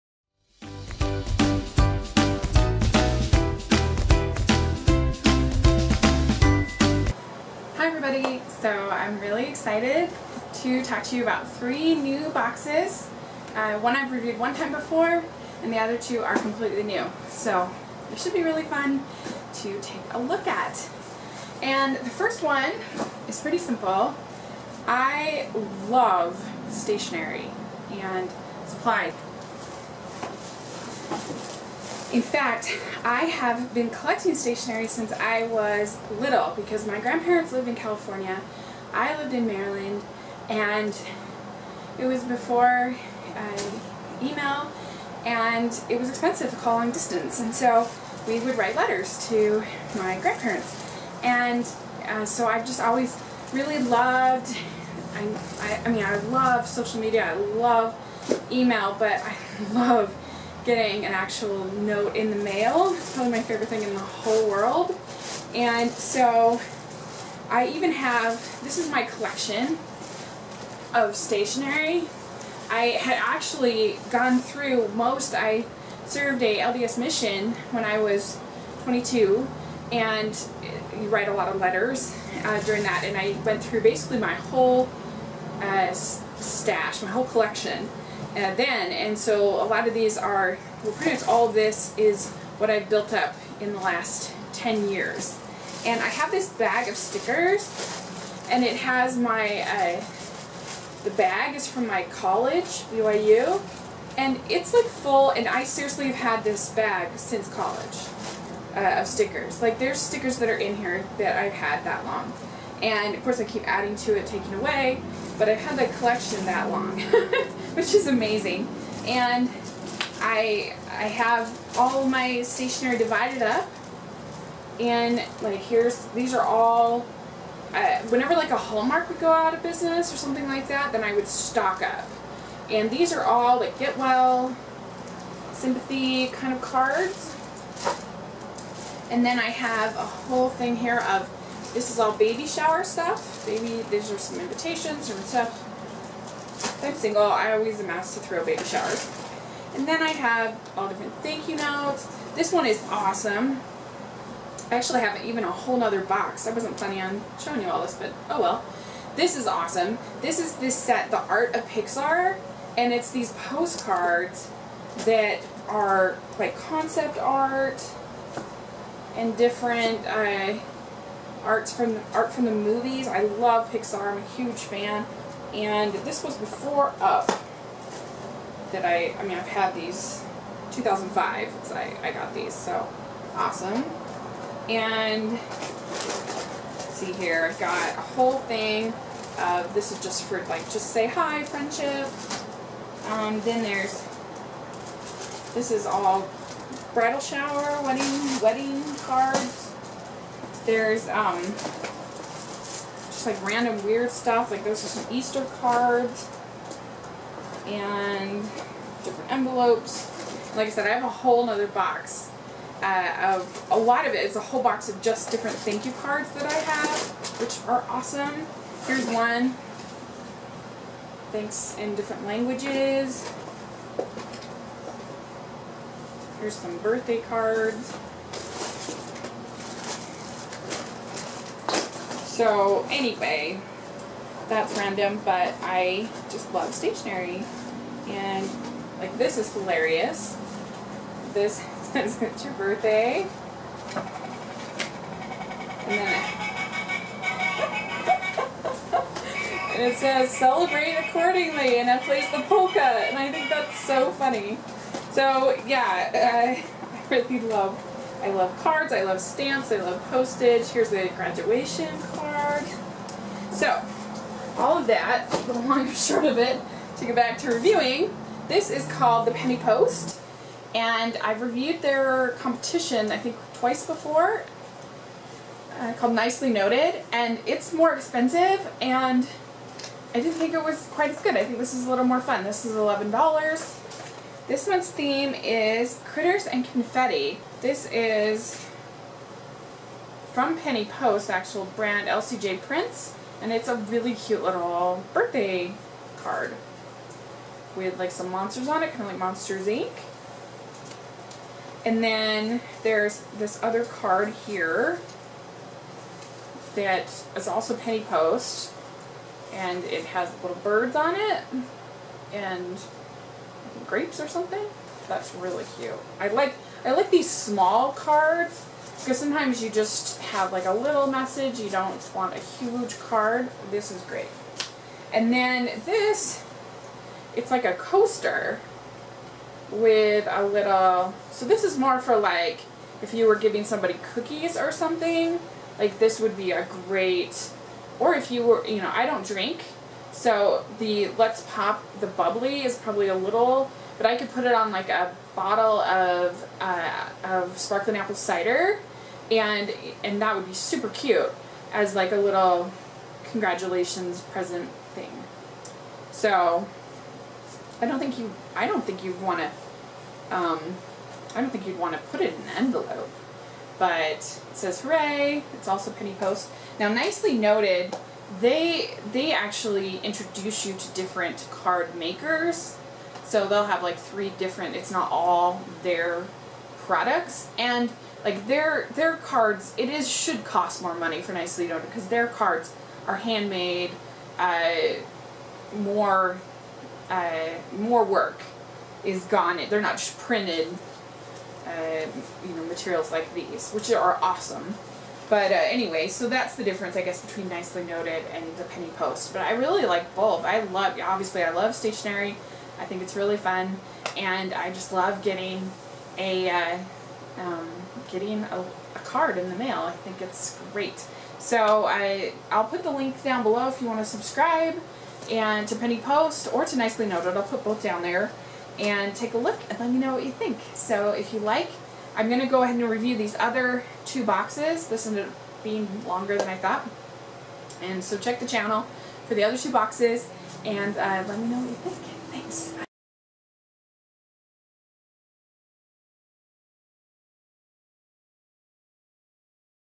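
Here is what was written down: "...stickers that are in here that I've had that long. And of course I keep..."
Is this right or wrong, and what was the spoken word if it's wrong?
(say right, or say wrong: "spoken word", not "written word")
right.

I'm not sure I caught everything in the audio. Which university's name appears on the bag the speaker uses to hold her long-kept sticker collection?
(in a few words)
BYU.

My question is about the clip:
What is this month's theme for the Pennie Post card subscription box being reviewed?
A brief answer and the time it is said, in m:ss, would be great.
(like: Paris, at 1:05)
Critters and Confetti, at 4:46.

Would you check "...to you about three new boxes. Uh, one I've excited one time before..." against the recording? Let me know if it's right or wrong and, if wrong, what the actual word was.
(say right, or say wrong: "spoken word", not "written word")
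wrong: "reviewed", not "excited".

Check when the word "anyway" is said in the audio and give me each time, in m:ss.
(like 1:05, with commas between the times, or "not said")
3:52, 6:35.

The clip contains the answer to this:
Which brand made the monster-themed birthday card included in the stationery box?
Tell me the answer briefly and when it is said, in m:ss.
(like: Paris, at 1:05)
LCJ Prints, at 4:52.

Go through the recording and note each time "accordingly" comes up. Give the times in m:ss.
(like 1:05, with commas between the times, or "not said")
4:11.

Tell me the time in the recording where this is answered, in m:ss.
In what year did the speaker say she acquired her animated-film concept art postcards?
3:00.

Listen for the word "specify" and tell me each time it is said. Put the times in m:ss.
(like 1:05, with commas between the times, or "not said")
not said.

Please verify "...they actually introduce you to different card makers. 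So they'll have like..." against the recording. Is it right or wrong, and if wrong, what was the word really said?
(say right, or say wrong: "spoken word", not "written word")
right.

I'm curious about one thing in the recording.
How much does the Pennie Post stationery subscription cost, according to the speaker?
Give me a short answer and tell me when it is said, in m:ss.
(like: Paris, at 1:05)
$11, at 4:42.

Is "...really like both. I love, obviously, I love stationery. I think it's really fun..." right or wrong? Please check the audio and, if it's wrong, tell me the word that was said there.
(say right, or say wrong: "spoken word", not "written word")
right.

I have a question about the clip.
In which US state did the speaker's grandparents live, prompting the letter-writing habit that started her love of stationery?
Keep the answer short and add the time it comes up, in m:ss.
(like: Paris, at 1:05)
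California, at 0:37.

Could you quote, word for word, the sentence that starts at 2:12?
And these are all like get well, sympathy kind of cards.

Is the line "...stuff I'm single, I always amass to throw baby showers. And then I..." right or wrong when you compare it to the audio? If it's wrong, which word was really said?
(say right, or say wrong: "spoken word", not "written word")
right.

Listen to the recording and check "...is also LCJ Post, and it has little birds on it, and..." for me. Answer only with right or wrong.
wrong.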